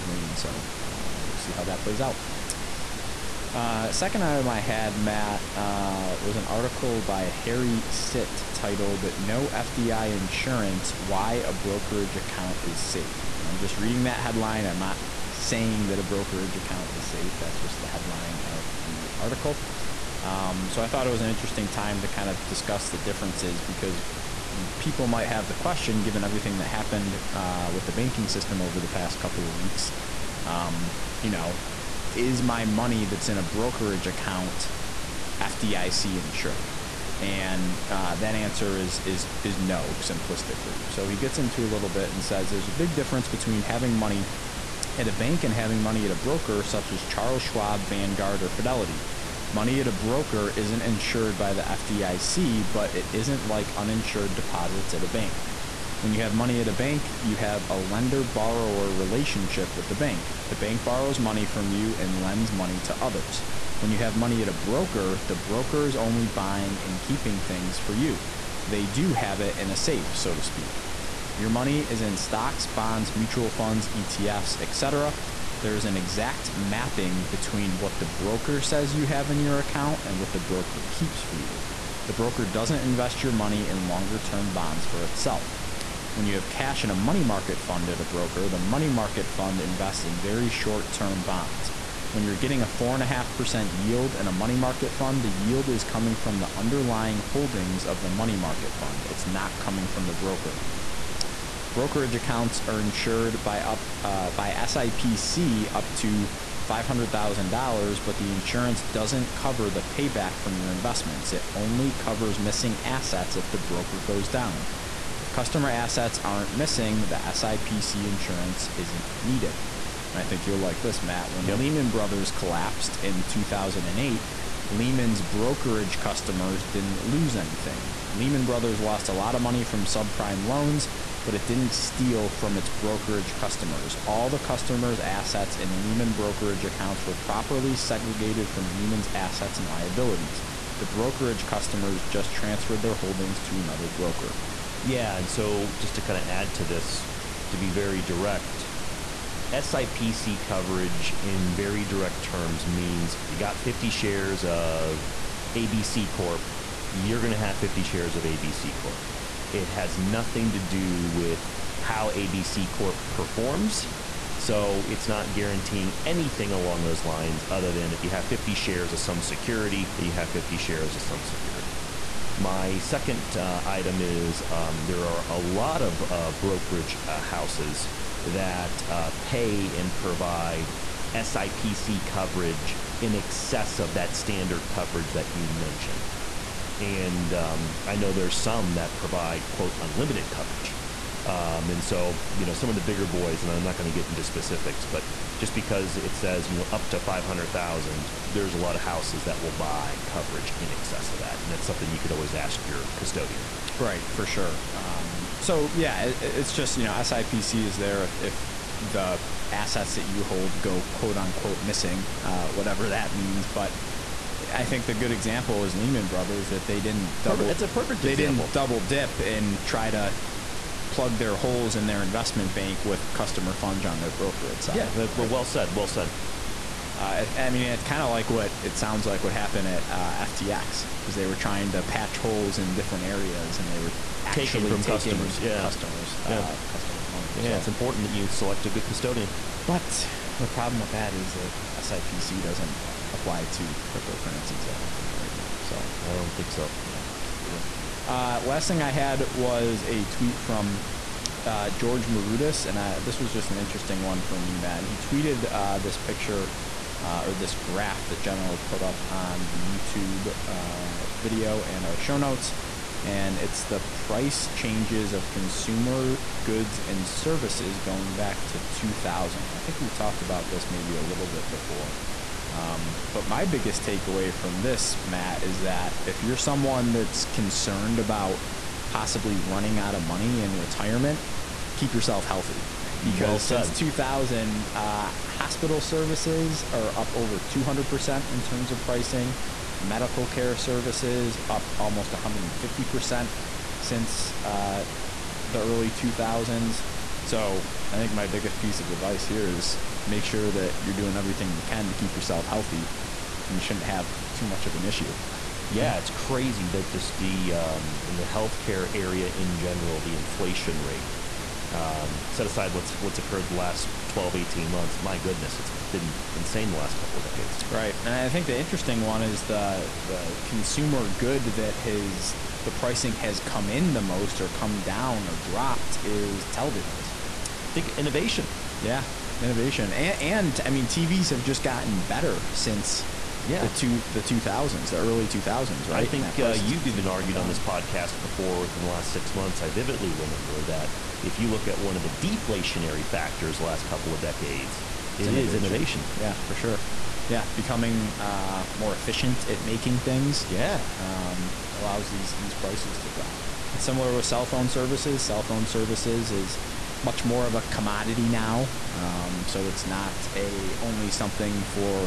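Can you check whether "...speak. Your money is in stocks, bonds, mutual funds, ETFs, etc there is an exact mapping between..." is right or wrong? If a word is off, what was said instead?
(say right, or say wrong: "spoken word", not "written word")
right.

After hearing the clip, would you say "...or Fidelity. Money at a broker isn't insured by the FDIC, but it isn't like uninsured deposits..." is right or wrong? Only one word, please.
right.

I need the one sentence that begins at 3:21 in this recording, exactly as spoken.
And that's something you could always ask your custodian.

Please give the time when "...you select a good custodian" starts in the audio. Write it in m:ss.
3:58.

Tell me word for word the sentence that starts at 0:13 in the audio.
And I'm just reading that headline.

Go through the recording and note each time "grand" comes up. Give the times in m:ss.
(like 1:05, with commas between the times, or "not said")
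not said.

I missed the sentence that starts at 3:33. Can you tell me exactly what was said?
But I think the good example is Lehman Brothers that they didn't double.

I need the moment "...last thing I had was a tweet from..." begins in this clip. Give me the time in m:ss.
4:08.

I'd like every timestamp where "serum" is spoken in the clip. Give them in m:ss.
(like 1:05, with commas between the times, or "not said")
not said.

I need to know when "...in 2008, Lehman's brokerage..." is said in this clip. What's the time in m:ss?
2:03.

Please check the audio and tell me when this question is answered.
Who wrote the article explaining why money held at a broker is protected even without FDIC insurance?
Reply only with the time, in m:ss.
0:07.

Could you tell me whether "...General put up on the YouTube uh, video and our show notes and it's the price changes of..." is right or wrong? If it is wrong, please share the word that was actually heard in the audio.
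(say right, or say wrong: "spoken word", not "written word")
right.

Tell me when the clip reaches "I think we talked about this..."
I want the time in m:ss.
4:29.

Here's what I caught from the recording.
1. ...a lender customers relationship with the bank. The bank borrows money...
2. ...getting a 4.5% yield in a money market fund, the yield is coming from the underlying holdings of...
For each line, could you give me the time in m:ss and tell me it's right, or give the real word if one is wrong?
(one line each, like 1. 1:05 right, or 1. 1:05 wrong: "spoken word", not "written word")
1. 0:57 wrong: "borrower", not "customers"
2. 1:32 right.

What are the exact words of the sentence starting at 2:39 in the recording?
It has nothing to do with how ABC Corp performs.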